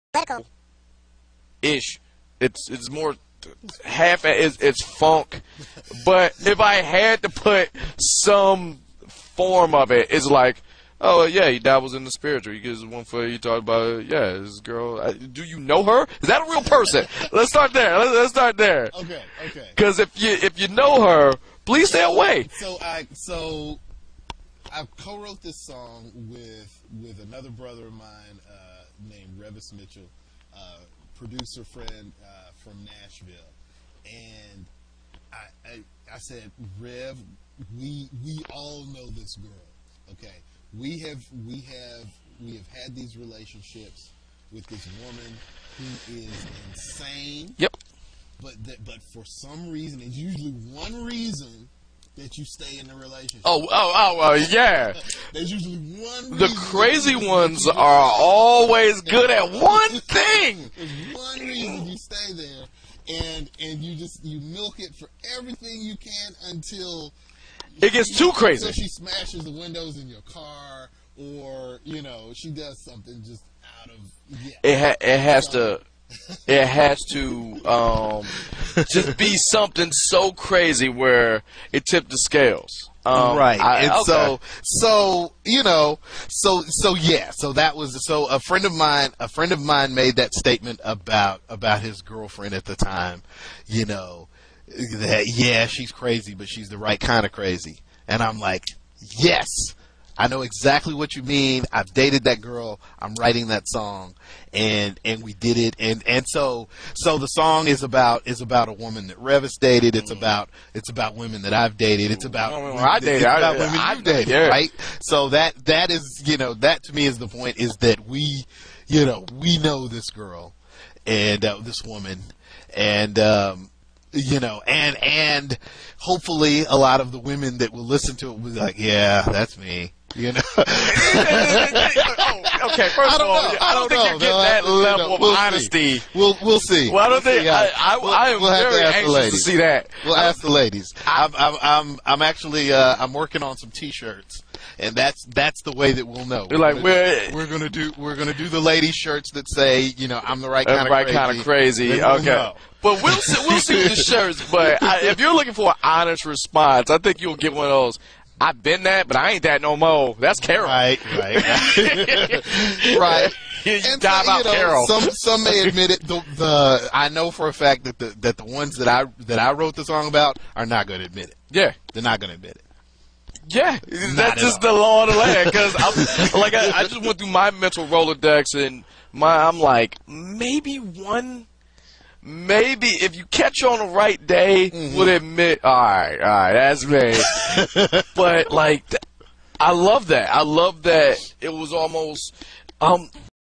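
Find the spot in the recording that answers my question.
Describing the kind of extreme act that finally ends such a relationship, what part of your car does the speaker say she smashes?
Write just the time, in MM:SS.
01:09.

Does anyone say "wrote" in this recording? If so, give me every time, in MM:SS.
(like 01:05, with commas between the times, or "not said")
00:24, 02:49.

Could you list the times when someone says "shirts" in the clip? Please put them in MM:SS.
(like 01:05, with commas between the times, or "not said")
02:23, 02:28, 02:33.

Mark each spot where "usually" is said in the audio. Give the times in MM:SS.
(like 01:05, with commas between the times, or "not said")
00:50, 00:55.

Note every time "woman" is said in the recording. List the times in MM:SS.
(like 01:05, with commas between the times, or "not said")
00:45, 01:48, 02:01.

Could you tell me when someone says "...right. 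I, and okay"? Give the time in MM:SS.
01:23.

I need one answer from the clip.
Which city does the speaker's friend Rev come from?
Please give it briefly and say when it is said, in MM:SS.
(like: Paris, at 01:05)
Nashville, at 00:32.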